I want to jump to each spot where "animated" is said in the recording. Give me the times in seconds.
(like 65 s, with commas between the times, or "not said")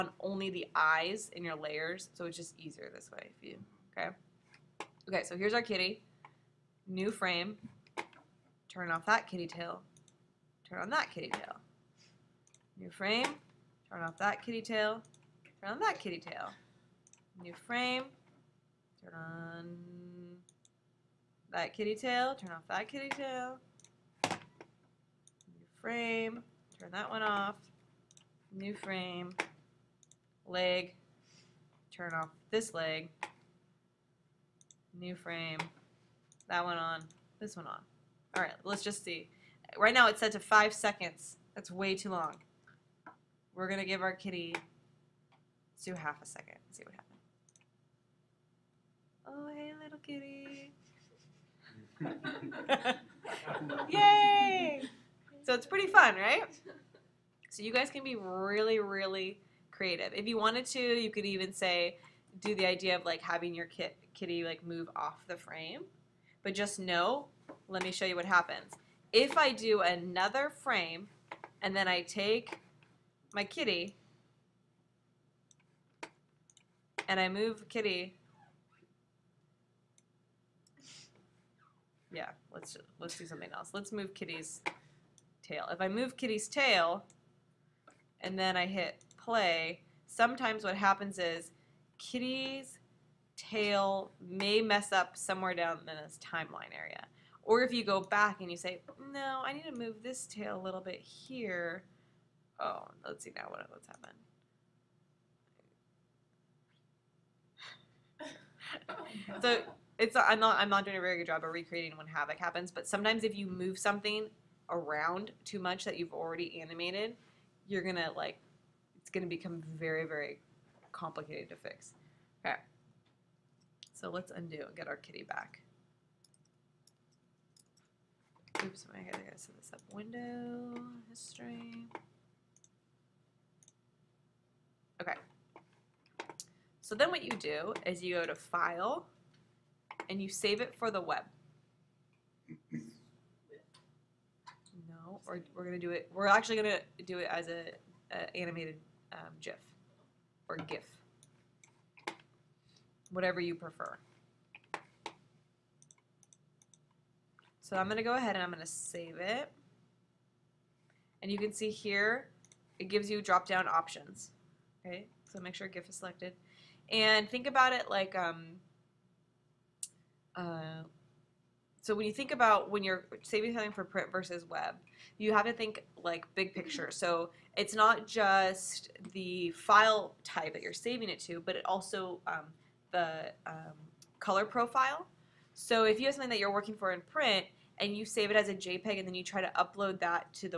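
116 s, 148 s.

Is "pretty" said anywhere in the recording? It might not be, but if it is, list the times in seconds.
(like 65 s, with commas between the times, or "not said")
55 s.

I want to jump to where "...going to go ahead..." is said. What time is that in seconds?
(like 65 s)
157 s.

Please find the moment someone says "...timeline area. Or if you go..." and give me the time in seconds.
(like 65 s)
96 s.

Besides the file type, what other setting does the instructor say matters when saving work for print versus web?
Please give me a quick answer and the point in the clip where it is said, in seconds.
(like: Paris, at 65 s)
color profile, at 184 s.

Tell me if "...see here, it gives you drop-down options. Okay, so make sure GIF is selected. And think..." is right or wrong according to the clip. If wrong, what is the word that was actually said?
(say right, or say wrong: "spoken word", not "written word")
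right.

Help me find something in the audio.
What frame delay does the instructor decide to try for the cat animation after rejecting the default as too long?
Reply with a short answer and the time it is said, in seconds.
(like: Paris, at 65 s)
half a second, at 45 s.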